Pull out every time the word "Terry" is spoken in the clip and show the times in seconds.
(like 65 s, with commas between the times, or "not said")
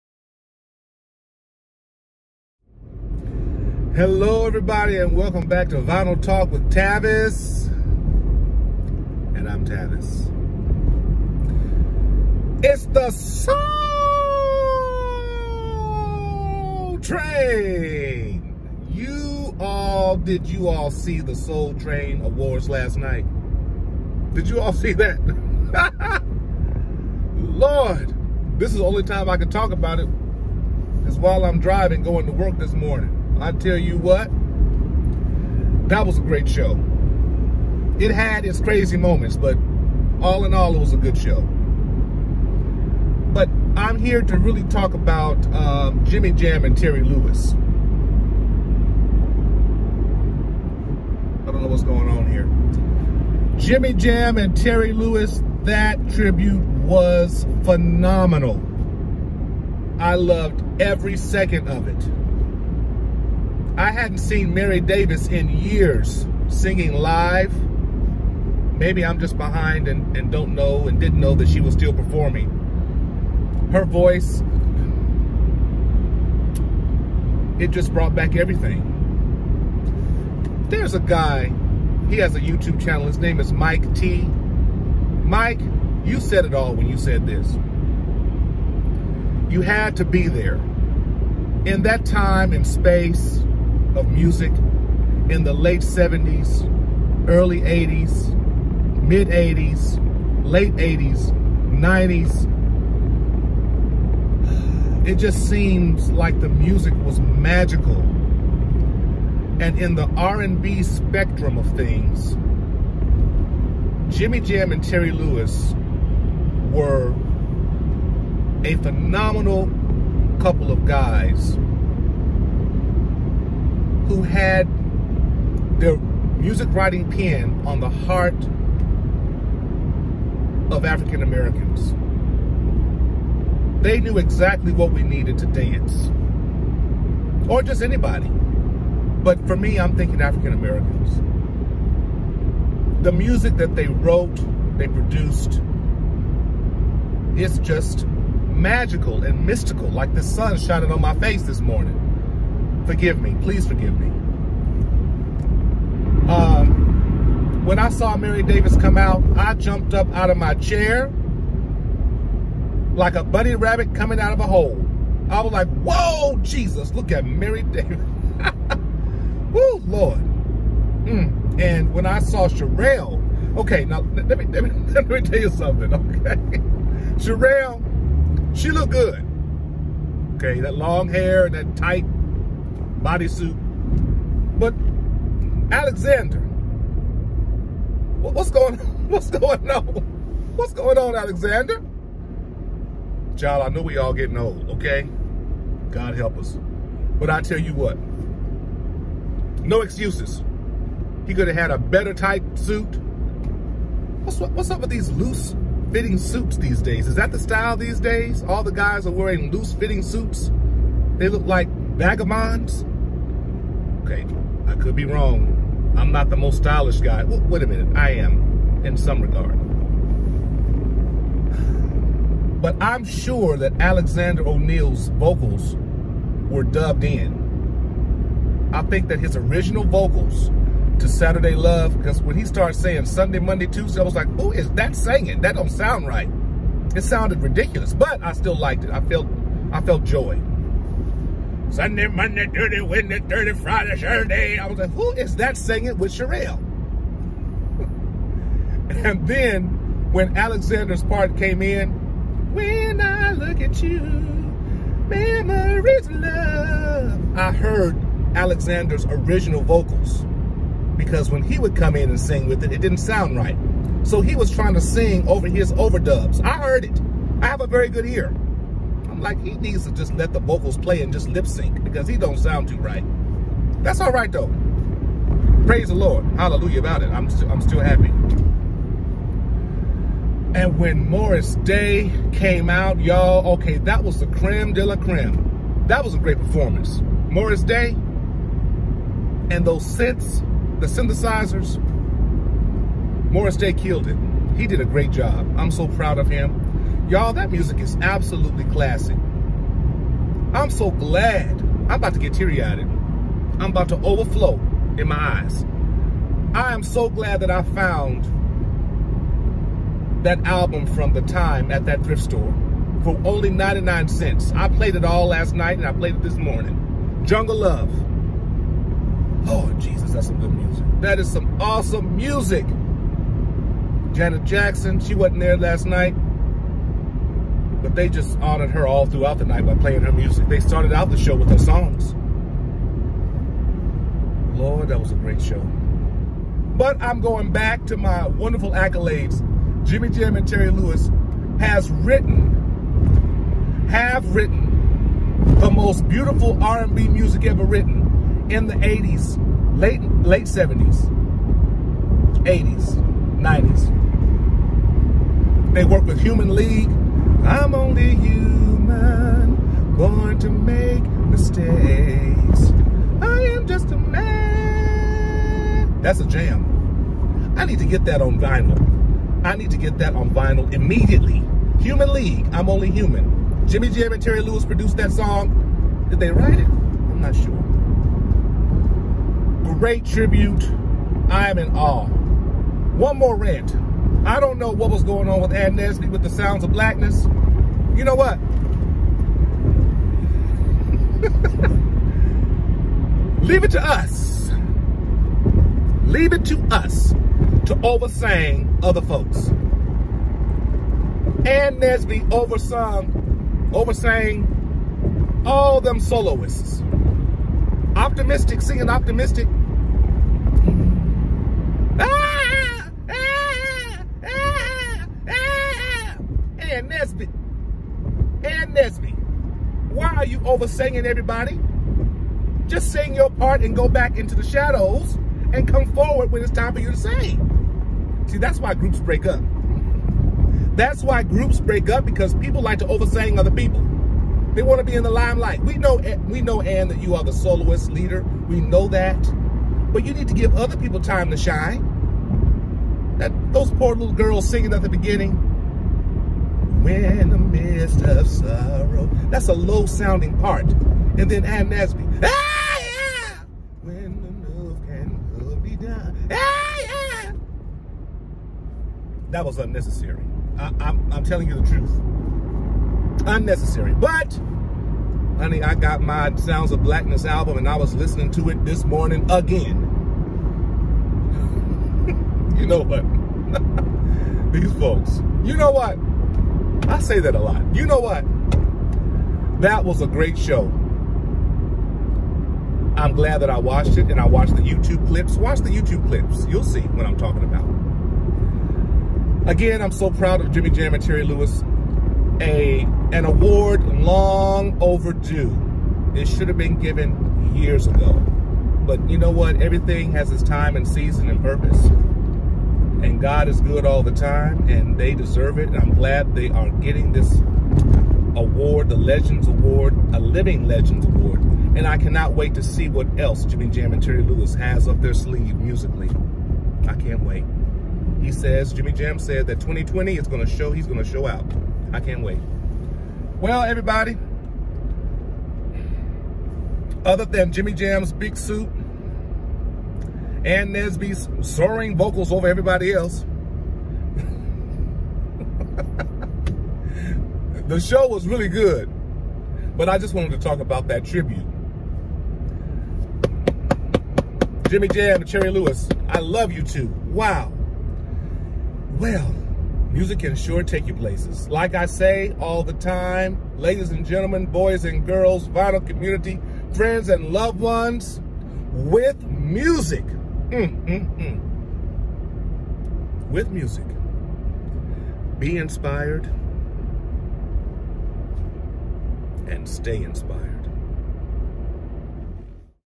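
46 s, 54 s, 114 s, 340 s, 374 s, 491 s, 514 s.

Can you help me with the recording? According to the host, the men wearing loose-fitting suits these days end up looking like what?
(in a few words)
vagabonds.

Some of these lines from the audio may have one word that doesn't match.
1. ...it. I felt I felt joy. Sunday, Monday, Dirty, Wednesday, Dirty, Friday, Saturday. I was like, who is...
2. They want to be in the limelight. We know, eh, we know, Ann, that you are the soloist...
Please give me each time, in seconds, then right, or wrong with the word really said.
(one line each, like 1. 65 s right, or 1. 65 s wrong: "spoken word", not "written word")
1. 238 s right
2. 434 s right.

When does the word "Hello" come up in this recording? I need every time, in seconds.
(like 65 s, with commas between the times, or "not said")
3 s.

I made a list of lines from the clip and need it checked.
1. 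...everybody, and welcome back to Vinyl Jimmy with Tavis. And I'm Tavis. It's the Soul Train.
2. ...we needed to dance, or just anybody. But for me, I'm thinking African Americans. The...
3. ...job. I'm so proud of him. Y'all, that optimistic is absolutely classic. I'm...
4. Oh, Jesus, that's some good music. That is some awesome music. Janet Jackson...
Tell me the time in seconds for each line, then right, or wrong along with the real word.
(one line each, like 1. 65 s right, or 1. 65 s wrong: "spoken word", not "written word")
1. 4 s wrong: "Talk", not "Jimmy"
2. 134 s right
3. 295 s wrong: "music", not "optimistic"
4. 319 s right.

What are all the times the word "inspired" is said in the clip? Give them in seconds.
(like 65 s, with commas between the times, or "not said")
565 s, 570 s.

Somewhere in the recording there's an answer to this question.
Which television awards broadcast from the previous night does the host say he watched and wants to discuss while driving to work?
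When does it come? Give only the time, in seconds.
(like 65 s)
21 s.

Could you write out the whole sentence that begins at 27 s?
Lord, this is the only time I can talk about it is while I'm driving going to work this morning.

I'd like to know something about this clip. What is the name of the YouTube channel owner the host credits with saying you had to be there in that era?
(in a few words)
Mike T.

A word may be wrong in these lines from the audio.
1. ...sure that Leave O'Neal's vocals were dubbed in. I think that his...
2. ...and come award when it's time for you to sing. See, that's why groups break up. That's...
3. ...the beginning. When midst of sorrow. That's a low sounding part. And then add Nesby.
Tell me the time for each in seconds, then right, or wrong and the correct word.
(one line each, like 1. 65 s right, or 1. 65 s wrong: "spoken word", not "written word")
1. 223 s wrong: "Alexander", not "Leave"
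2. 425 s wrong: "forward", not "award"
3. 444 s right.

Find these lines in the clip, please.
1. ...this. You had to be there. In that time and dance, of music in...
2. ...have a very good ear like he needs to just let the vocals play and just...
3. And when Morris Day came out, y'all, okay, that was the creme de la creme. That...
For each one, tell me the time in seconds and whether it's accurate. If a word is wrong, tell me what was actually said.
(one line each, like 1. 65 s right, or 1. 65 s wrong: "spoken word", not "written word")
1. 87 s wrong: "space", not "dance"
2. 267 s right
3. 280 s right.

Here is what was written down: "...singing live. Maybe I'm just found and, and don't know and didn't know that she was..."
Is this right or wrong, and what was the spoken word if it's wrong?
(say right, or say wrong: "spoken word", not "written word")
wrong: "behind", not "found".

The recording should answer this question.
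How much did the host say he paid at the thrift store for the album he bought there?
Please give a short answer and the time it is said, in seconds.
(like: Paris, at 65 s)
99 cents, at 313 s.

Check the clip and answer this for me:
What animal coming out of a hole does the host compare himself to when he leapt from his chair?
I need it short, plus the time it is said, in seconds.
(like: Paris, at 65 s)
bunny rabbit, at 163 s.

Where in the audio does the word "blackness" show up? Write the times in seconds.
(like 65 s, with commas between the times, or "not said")
386 s, 466 s.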